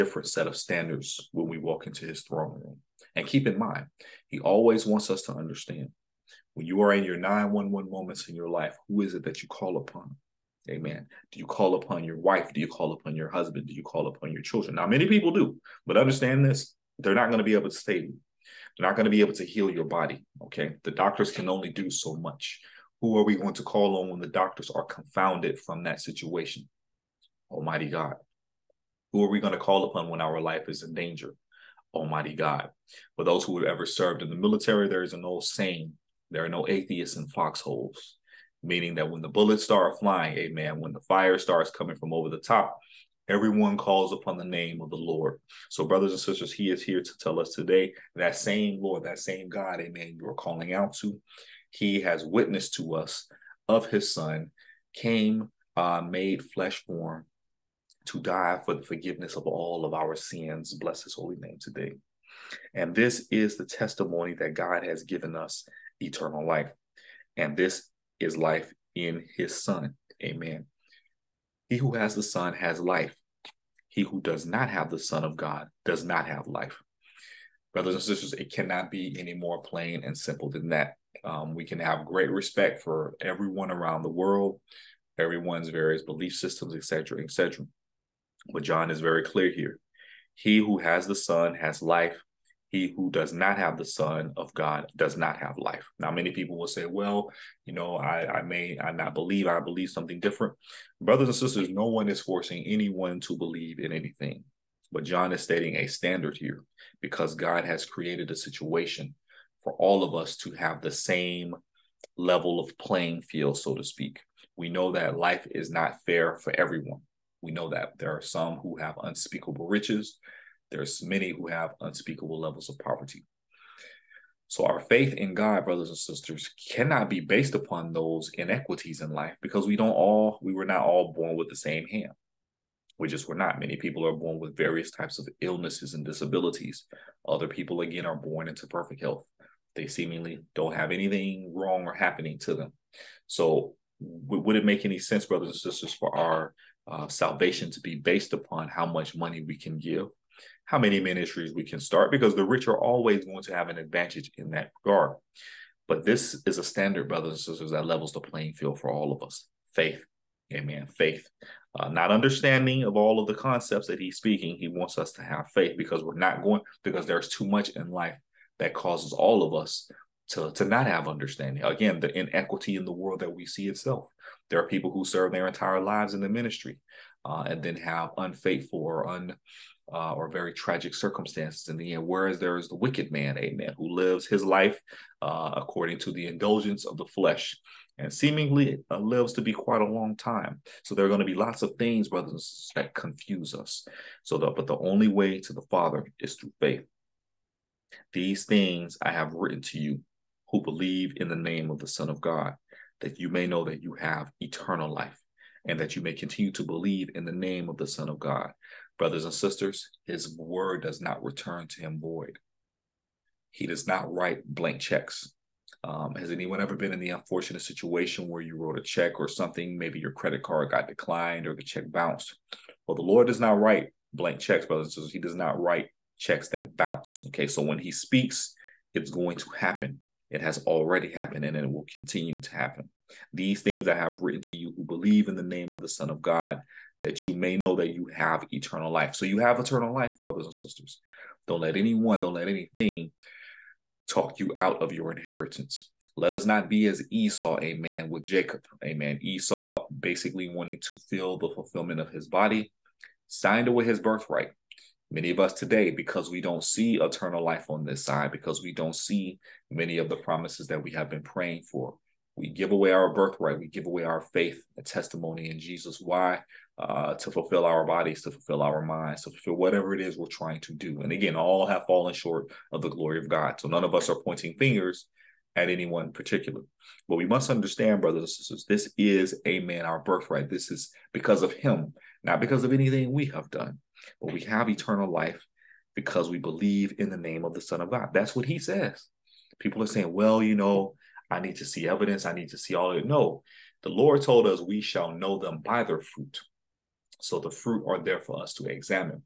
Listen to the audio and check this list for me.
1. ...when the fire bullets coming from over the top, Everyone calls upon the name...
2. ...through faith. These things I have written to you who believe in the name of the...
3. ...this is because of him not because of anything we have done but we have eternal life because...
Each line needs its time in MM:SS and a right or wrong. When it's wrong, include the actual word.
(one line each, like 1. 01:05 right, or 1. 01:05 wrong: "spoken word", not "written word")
1. 00:40 wrong: "starts", not "bullets"
2. 03:16 right
3. 04:40 right.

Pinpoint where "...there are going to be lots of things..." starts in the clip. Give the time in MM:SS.
03:10.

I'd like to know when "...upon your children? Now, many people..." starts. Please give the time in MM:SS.
00:14.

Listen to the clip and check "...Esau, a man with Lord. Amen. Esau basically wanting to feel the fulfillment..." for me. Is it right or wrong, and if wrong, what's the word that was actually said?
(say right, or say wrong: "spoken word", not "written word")
wrong: "Jacob", not "Lord".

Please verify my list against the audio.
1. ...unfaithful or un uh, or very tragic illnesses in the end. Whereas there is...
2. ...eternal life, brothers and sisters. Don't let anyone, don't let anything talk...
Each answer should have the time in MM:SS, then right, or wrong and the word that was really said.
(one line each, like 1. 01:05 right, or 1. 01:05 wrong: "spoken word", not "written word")
1. 02:58 wrong: "circumstances", not "illnesses"
2. 03:59 right.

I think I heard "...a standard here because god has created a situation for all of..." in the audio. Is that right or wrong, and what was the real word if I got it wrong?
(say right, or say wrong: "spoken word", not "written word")
right.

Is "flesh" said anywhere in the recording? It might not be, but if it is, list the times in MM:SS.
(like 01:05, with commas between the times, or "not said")
00:56, 03:07.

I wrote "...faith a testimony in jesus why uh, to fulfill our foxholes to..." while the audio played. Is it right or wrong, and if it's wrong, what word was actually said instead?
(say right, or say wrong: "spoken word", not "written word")
wrong: "bodies", not "foxholes".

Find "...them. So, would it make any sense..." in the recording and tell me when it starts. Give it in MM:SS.
02:22.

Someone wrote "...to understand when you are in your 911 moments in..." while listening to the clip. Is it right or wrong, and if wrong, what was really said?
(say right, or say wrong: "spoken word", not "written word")
right.